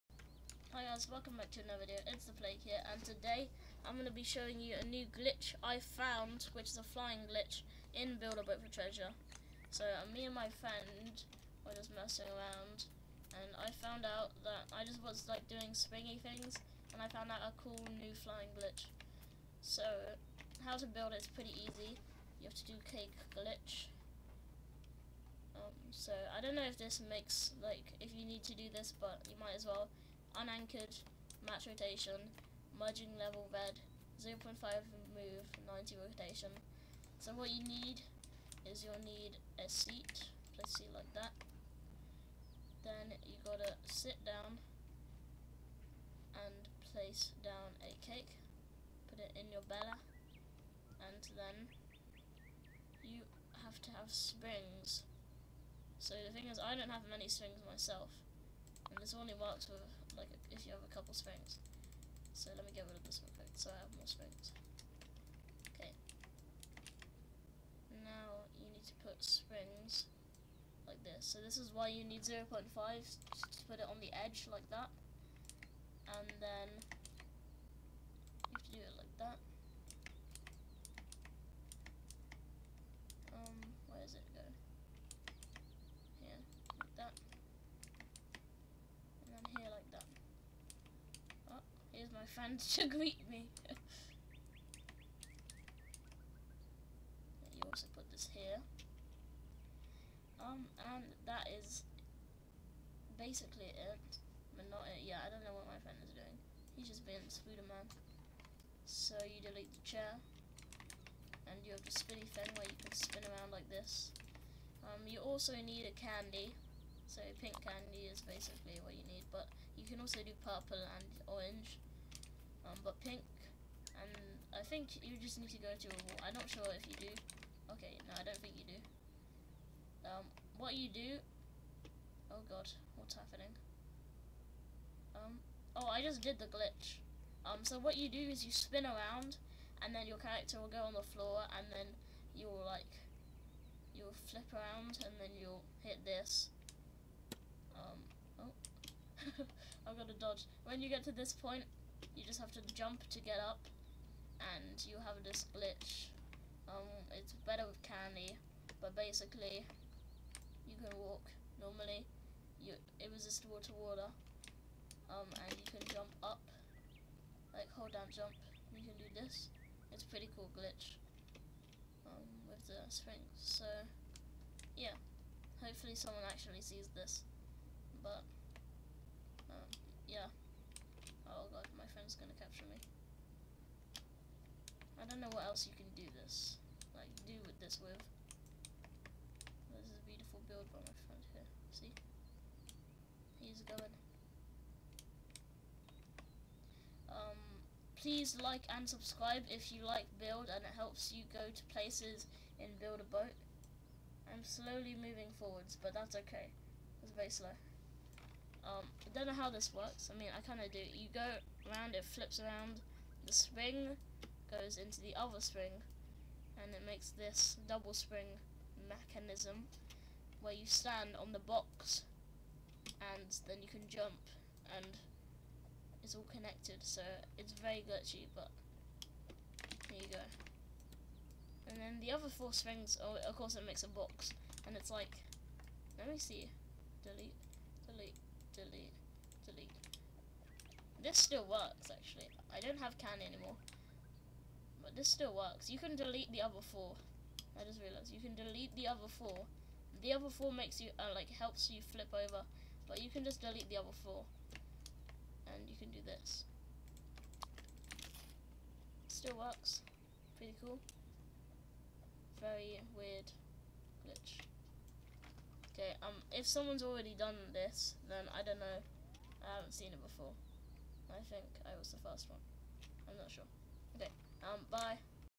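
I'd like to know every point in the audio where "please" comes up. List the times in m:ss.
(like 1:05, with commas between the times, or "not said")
3:17.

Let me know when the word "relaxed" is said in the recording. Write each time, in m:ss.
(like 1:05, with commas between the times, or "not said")
not said.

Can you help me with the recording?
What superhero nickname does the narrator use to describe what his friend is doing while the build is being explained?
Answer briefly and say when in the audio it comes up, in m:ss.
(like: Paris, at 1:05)
Spooder Man, at 1:47.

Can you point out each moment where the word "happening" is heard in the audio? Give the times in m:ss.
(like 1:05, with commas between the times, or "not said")
2:13.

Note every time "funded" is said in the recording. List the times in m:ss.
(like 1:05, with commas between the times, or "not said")
not said.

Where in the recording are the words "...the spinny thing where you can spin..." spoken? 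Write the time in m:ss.
1:51.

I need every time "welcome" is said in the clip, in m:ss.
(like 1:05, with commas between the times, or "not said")
0:01.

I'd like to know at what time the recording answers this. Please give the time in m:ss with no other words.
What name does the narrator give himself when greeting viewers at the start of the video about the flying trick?
0:02.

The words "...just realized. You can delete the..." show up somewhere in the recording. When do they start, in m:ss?
4:07.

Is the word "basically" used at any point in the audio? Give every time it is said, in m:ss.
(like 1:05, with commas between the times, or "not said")
1:43, 1:58, 2:38.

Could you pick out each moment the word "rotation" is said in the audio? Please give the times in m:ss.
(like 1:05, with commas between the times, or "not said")
0:31, 0:36.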